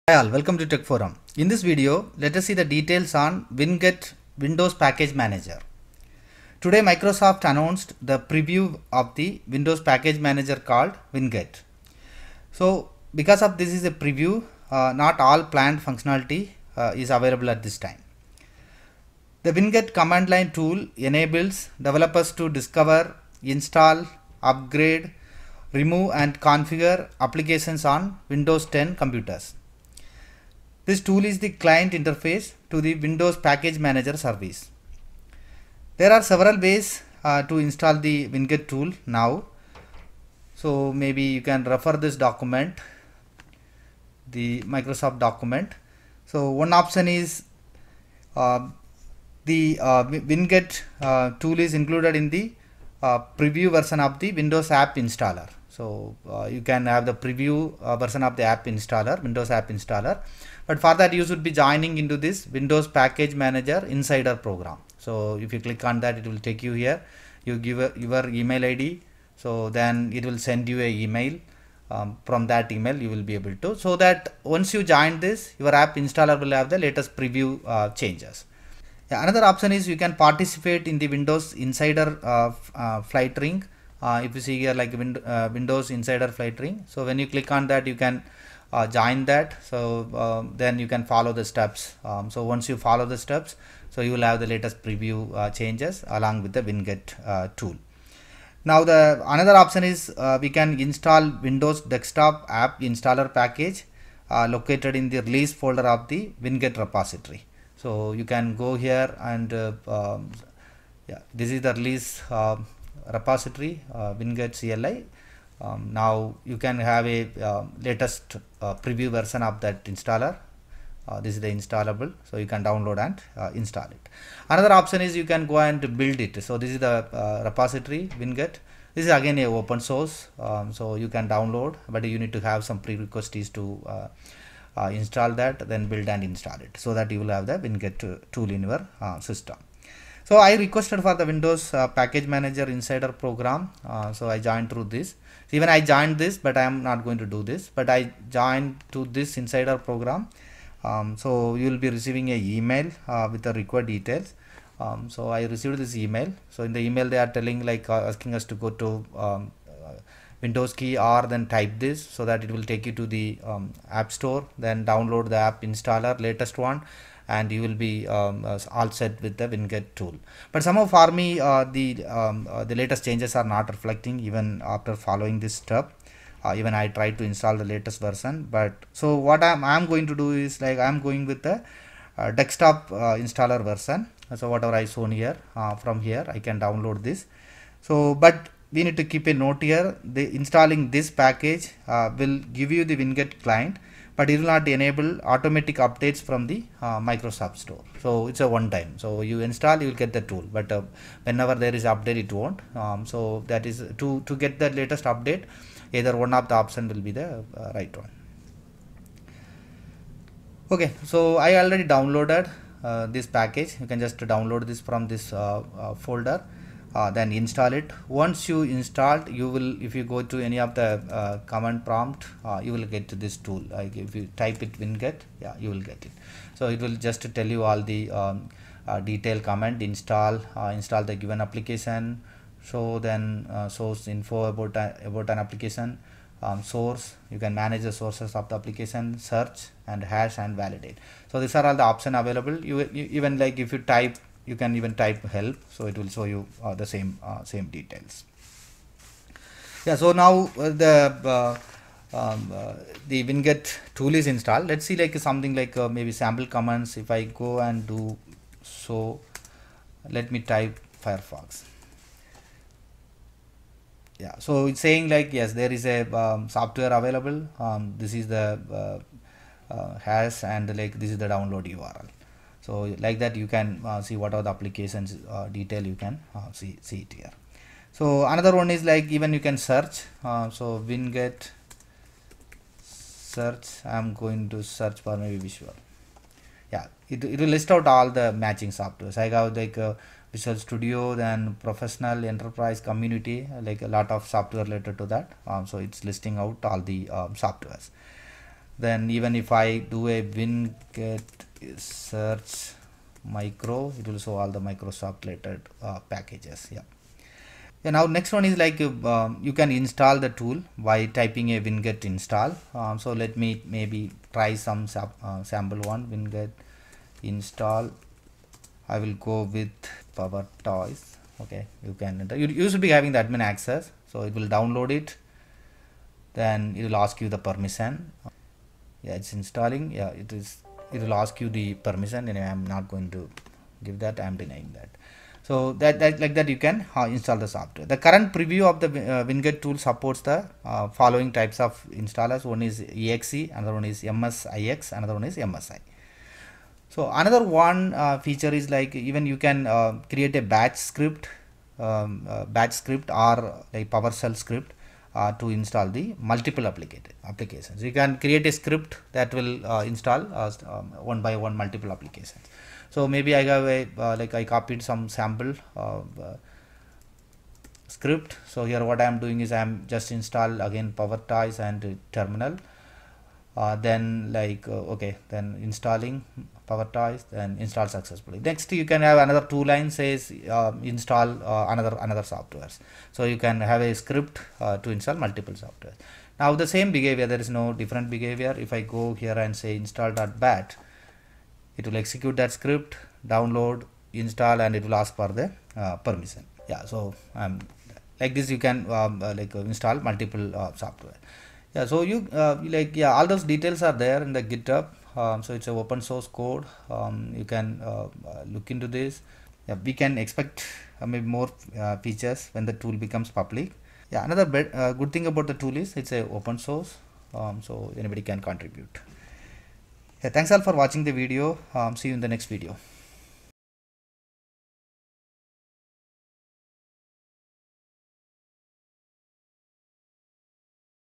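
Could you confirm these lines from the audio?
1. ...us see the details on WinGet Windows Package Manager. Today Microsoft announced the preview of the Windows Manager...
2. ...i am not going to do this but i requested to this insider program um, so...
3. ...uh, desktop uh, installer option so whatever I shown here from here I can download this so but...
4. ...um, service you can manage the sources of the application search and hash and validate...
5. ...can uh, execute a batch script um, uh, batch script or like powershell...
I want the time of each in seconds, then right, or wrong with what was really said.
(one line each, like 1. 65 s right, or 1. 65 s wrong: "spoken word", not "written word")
1. 2 s wrong: "Package", not "Manager"
2. 146 s wrong: "joined", not "requested"
3. 182 s wrong: "version", not "option"
4. 236 s wrong: "source", not "service"
5. 349 s wrong: "create", not "execute".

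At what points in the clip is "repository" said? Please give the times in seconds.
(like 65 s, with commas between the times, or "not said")
106 s, 113 s, 127 s.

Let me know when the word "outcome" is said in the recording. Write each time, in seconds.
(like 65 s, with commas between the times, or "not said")
not said.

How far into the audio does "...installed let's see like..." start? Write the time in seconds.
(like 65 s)
254 s.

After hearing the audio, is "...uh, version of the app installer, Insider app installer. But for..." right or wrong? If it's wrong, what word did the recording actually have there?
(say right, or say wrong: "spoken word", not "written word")
wrong: "Windows", not "Insider".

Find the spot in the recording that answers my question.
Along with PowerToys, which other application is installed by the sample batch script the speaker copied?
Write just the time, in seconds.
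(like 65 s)
372 s.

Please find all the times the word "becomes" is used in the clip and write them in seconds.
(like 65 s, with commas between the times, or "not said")
413 s.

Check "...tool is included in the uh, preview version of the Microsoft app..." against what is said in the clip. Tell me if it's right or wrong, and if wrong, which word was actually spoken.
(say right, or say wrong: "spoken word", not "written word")
wrong: "Windows", not "Microsoft".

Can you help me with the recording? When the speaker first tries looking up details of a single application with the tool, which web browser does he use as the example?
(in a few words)
Firefox.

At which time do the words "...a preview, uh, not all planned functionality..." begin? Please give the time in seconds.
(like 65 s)
13 s.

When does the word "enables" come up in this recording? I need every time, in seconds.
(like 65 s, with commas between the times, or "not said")
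20 s, 194 s.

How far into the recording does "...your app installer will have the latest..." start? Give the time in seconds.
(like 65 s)
75 s.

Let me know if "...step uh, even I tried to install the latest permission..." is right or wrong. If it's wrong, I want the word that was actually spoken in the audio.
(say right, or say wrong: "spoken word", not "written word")
wrong: "version", not "permission".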